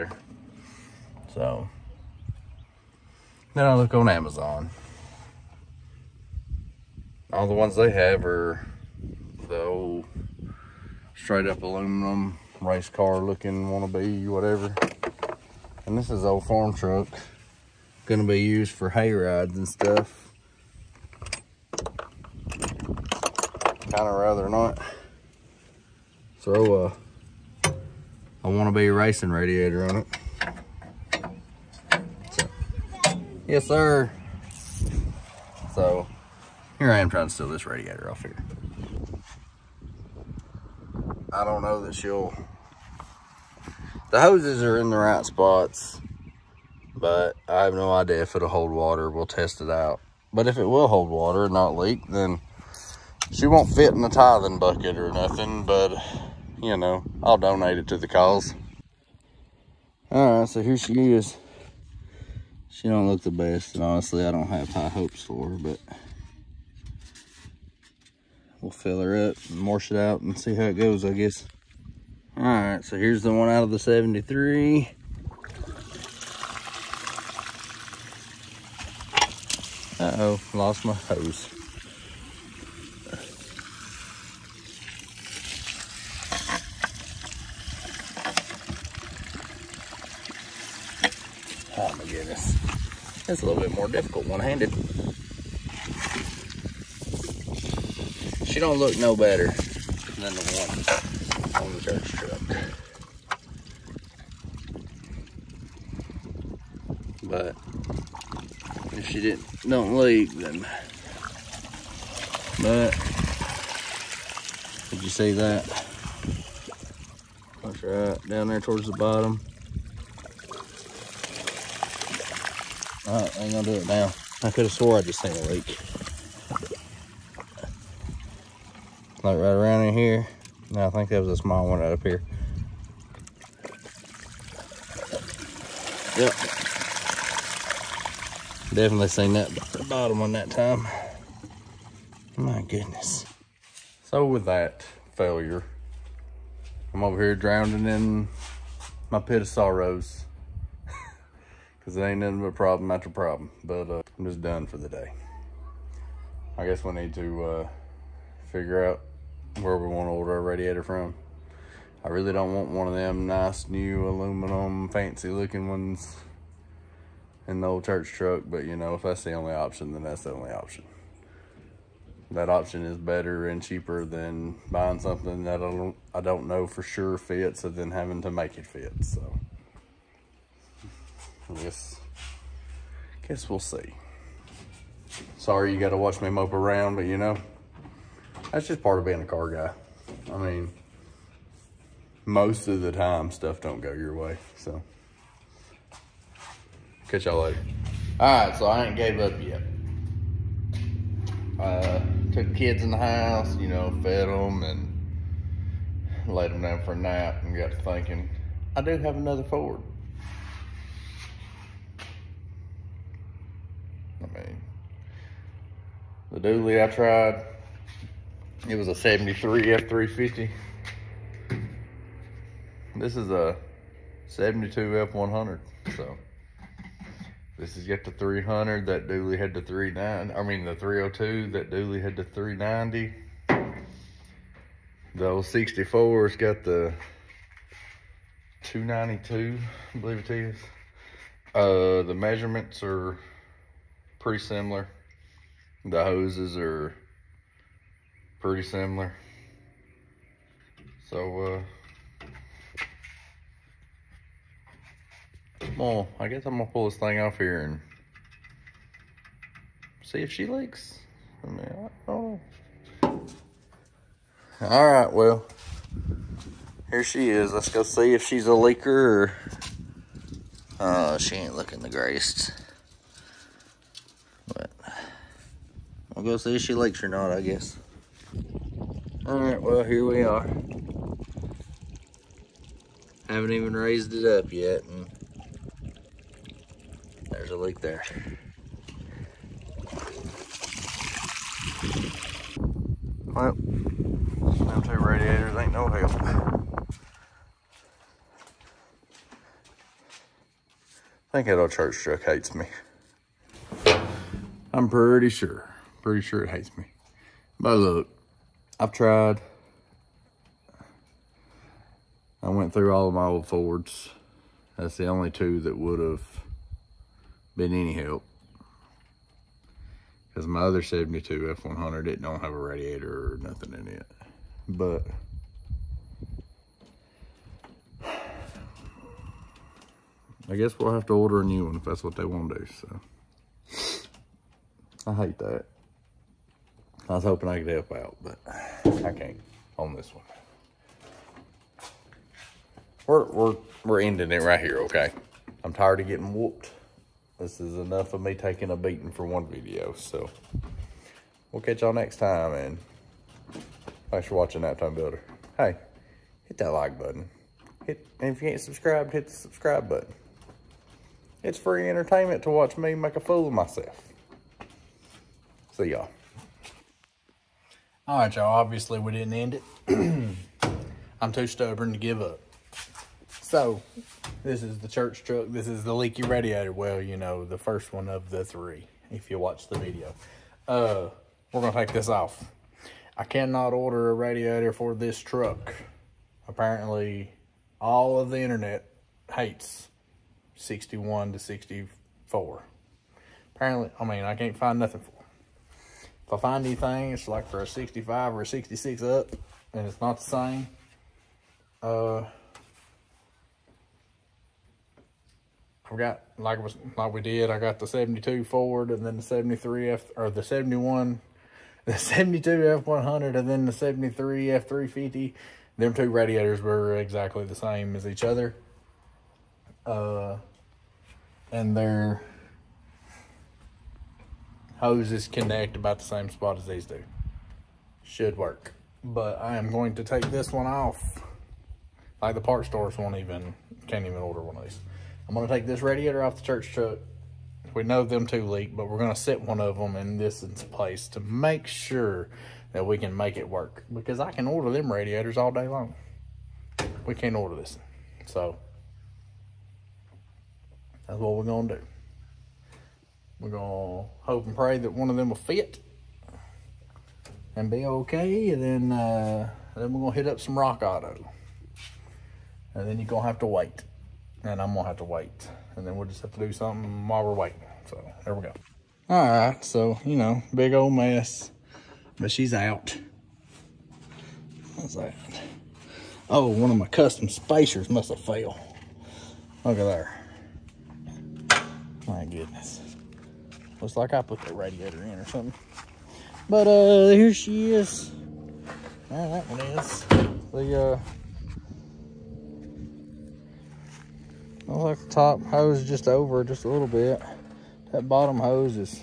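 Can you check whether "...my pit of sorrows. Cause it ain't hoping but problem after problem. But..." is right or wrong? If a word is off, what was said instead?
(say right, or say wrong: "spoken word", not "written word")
wrong: "nothing", not "hoping".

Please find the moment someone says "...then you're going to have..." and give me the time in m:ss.
7:42.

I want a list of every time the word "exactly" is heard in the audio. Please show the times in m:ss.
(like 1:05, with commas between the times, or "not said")
6:56.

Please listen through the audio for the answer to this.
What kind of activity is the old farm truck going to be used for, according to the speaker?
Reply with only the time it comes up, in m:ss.
0:18.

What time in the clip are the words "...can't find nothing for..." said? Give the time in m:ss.
6:34.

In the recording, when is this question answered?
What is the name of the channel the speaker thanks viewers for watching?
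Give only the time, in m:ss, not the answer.
5:54.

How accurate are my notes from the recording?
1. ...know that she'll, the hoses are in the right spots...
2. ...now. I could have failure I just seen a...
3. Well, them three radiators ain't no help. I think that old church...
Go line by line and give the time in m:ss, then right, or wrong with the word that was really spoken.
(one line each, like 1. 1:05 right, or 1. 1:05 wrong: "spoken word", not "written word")
1. 0:41 right
2. 2:03 wrong: "swore", not "failure"
3. 4:53 wrong: "two", not "three".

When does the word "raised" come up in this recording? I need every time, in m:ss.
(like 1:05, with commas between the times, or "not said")
4:43.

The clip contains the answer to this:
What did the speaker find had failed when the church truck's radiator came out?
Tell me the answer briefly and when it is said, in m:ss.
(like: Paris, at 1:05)
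Custom spacers, at 7:56.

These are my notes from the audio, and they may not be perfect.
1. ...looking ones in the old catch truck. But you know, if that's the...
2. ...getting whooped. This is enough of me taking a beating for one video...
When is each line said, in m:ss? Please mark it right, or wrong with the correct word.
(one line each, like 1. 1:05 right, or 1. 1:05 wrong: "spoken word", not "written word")
1. 2:45 wrong: "church", not "catch"
2. 5:46 right.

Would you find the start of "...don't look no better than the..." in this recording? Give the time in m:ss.
1:38.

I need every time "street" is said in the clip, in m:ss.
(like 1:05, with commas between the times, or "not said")
not said.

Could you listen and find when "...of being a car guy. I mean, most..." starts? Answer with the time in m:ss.
3:08.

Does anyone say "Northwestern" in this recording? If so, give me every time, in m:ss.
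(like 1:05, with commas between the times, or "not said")
not said.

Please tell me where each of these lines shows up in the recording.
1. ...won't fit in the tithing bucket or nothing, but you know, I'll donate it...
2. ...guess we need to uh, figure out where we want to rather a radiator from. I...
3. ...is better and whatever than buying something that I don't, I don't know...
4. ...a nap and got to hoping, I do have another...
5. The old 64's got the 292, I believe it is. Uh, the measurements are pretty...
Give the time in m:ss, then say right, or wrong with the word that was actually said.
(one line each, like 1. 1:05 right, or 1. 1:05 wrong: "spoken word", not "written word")
1. 0:53 right
2. 2:36 wrong: "order", not "rather"
3. 2:52 wrong: "cheaper", not "whatever"
4. 3:26 wrong: "thinking", not "hoping"
5. 3:55 right.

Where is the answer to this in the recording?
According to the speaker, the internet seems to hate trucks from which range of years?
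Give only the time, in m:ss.
6:30.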